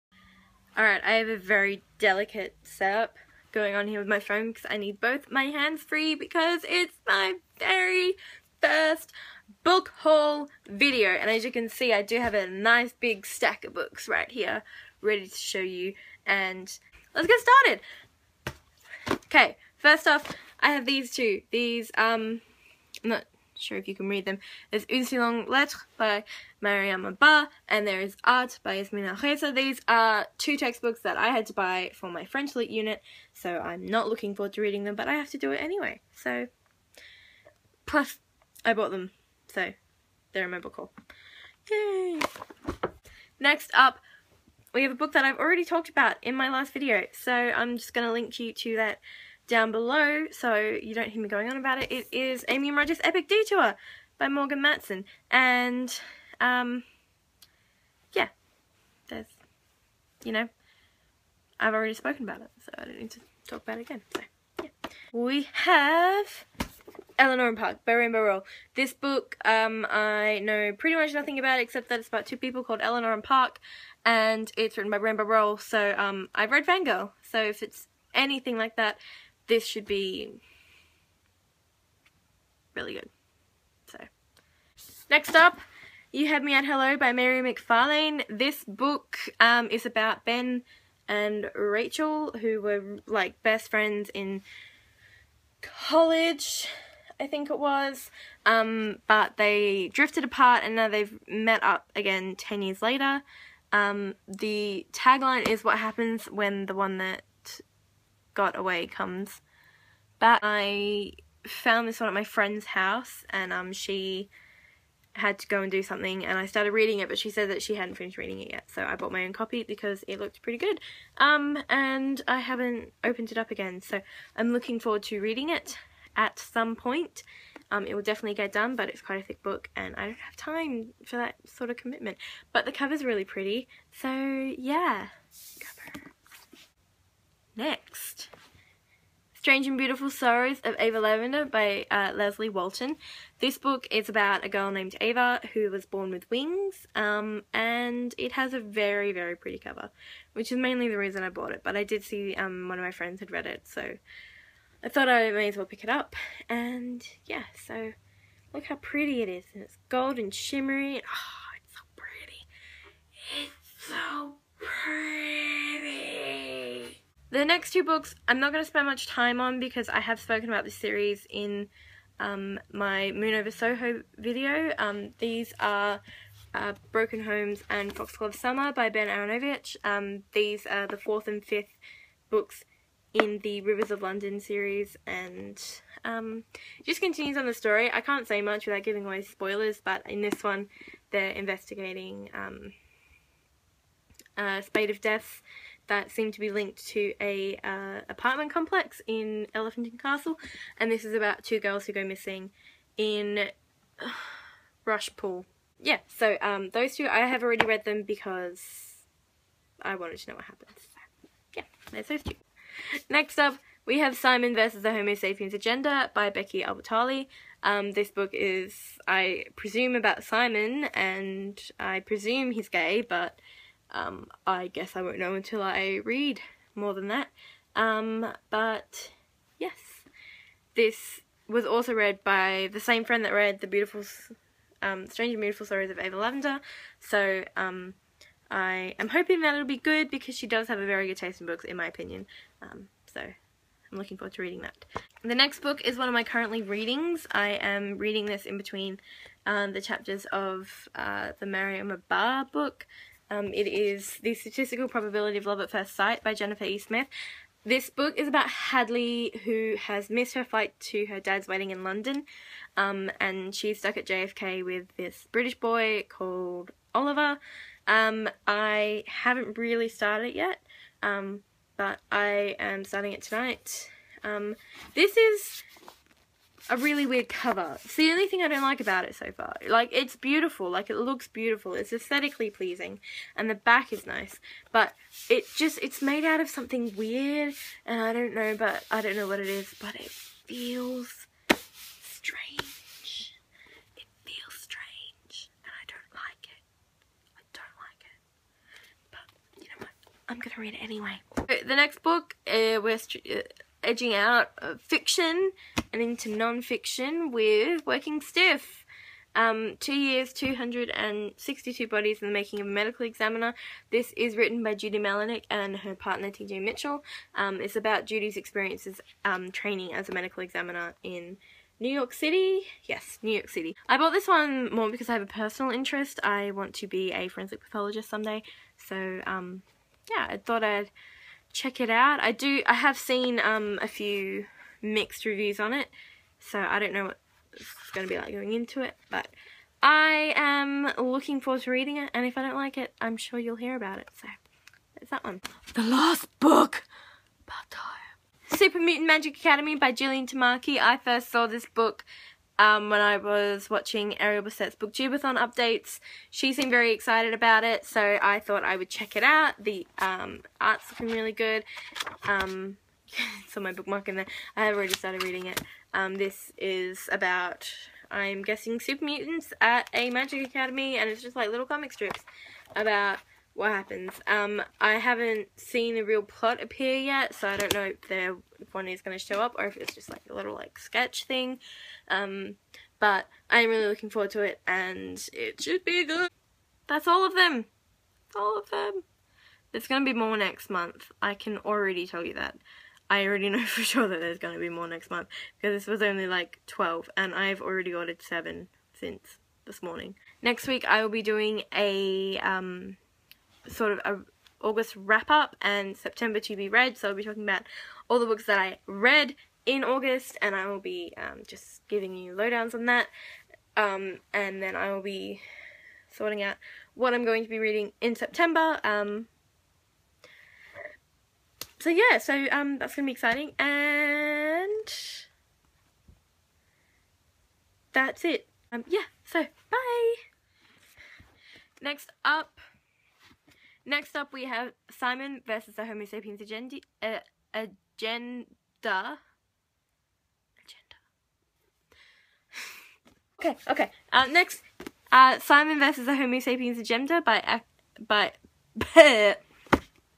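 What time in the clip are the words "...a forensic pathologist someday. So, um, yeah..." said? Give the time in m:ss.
5:27.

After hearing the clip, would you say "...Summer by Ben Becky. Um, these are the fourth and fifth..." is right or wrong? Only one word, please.
wrong.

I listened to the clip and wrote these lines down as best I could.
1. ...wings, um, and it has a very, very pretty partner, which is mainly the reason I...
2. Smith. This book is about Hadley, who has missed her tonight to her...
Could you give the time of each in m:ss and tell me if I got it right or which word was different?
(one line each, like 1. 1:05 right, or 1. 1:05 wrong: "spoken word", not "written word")
1. 2:26 wrong: "cover", not "partner"
2. 4:16 wrong: "flight", not "tonight".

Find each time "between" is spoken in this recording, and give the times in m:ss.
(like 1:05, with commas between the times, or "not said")
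4:08.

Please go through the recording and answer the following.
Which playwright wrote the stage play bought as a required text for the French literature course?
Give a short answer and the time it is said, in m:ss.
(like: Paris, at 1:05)
Yasmina Reza, at 0:28.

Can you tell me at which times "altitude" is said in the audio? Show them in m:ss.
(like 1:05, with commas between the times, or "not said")
not said.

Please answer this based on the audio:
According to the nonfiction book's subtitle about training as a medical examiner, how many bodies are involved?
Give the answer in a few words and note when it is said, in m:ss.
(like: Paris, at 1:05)
262, at 5:10.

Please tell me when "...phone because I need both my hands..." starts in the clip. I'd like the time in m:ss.
0:04.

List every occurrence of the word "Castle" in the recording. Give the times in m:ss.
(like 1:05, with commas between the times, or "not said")
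3:20.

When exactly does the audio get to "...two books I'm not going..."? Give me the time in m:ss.
2:47.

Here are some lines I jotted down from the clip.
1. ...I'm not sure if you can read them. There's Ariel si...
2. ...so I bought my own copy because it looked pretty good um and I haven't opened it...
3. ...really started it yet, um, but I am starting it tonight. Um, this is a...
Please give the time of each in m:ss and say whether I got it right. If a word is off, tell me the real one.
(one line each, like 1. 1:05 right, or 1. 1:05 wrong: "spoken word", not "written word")
1. 0:23 wrong: "Une", not "Ariel"
2. 1:58 right
3. 4:29 right.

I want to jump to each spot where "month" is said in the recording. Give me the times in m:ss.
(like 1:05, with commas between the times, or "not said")
6:30, 6:35.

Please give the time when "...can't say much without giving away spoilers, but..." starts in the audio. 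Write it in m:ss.
3:08.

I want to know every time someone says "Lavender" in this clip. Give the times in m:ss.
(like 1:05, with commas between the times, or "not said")
2:21, 3:56.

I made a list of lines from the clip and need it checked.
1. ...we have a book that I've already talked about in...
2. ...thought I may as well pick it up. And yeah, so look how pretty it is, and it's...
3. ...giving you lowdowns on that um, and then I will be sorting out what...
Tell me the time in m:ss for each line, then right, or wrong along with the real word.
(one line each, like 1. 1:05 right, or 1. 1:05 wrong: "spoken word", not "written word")
1. 0:44 right
2. 2:34 right
3. 6:51 right.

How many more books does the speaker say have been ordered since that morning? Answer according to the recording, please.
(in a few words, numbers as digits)
7.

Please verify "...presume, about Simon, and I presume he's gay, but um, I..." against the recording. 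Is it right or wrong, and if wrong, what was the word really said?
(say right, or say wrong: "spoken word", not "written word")
right.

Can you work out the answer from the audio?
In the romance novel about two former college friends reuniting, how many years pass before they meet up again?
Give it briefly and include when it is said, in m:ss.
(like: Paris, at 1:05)
10, at 1:42.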